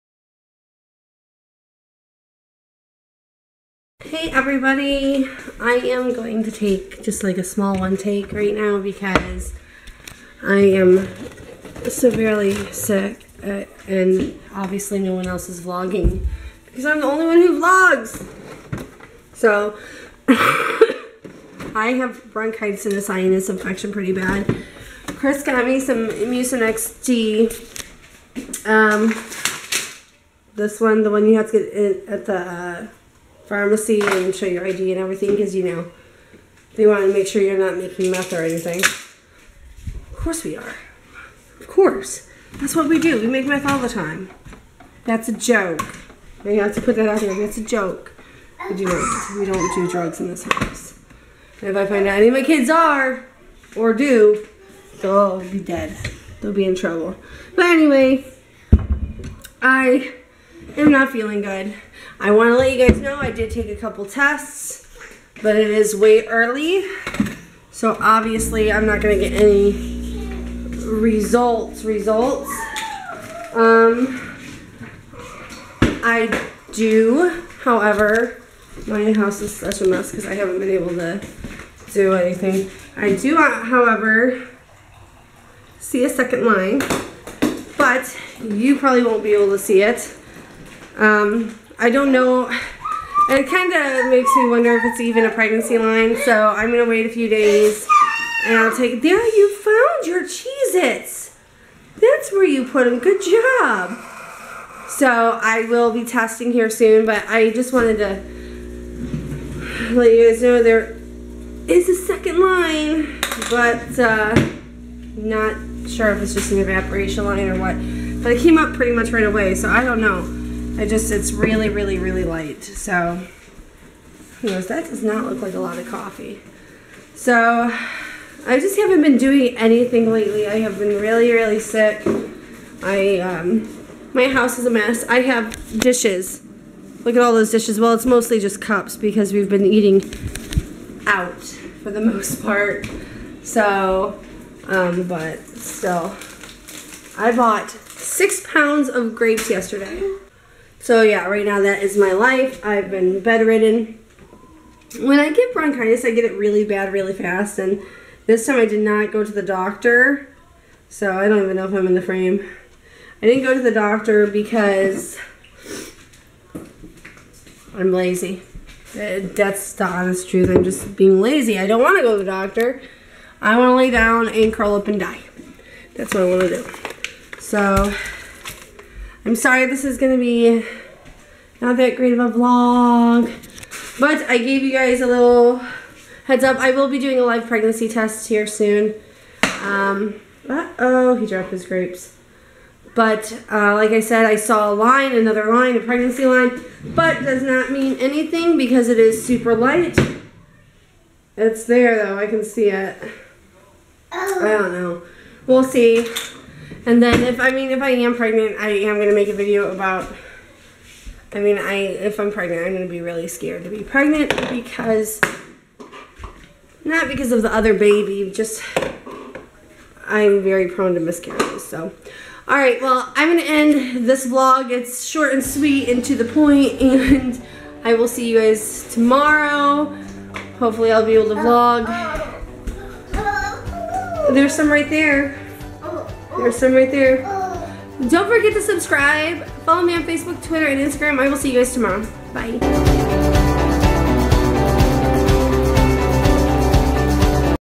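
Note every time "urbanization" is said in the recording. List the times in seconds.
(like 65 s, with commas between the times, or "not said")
not said.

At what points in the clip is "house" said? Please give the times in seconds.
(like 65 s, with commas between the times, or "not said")
50 s, 79 s, 134 s.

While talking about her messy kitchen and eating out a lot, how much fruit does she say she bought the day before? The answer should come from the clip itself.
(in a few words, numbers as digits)
6 pounds.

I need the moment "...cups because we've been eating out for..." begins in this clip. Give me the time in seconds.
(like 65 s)
138 s.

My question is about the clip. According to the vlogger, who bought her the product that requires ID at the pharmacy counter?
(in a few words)
Chris.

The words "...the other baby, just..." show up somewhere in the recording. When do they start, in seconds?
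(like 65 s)
217 s.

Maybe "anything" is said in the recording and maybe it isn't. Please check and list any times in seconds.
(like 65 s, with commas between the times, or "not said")
38 s, 82 s, 129 s, 197 s.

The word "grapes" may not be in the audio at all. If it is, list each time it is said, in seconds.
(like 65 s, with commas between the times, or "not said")
149 s, 191 s.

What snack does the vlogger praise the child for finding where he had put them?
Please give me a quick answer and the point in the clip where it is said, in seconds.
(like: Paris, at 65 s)
Cheez Its, at 100 s.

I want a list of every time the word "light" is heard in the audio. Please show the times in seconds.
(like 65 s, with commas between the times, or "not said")
122 s, 199 s.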